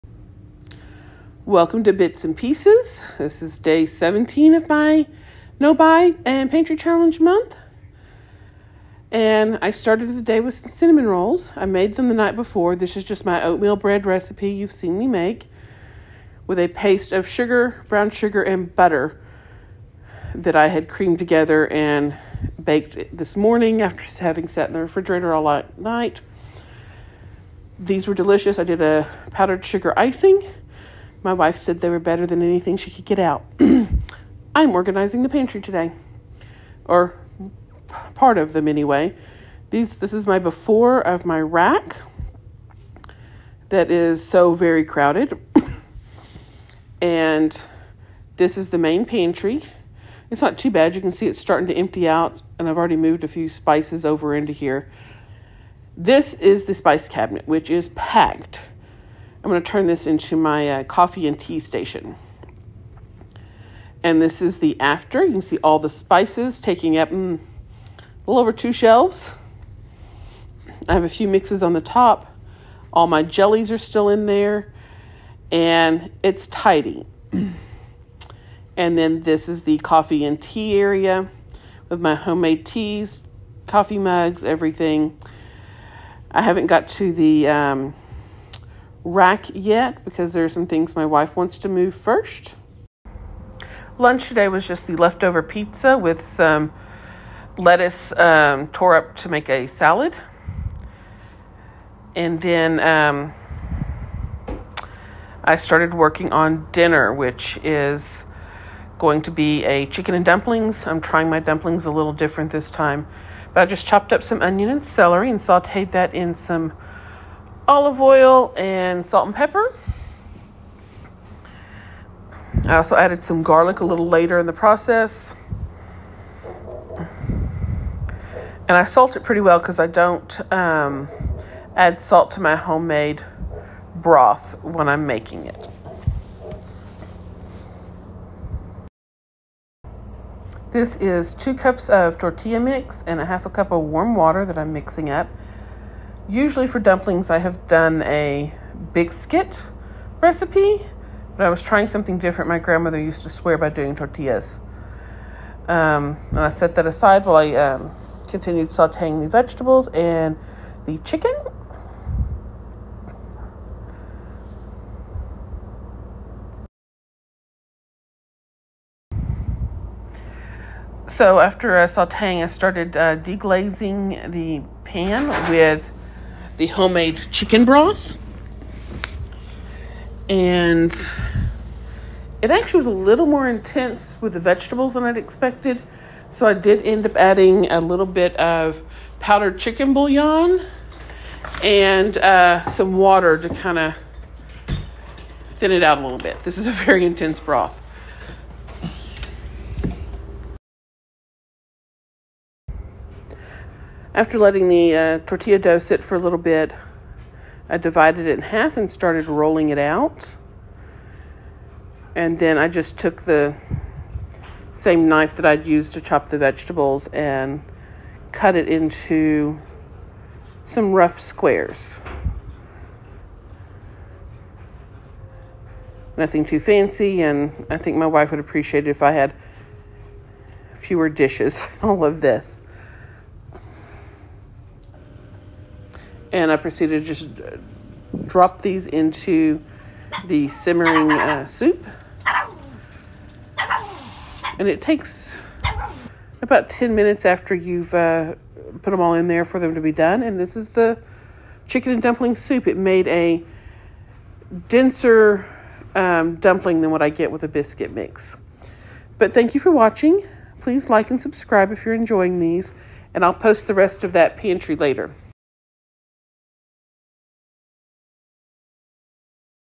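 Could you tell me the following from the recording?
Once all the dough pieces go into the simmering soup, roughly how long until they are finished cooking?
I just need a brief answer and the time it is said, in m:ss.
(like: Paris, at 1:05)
10 minutes, at 4:06.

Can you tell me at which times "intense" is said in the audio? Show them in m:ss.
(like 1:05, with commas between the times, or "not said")
3:03, 3:17.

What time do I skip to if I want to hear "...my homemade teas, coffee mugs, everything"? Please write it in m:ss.
1:21.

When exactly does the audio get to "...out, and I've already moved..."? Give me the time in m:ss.
0:52.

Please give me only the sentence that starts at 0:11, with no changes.
I made them the night before.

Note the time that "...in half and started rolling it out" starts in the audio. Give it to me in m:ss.
3:28.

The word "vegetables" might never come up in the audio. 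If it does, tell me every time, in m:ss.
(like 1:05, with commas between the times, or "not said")
2:39, 3:04, 3:36.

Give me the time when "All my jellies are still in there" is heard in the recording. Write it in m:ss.
1:12.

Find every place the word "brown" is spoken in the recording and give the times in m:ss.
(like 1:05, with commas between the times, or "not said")
0:17.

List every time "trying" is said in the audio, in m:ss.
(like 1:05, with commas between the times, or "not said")
1:51, 2:31.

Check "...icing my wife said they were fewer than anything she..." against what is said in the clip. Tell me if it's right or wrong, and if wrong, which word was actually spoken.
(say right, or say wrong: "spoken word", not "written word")
wrong: "better", not "fewer".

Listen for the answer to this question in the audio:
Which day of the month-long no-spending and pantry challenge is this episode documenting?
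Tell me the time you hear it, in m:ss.
0:03.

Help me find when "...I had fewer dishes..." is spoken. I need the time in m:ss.
3:49.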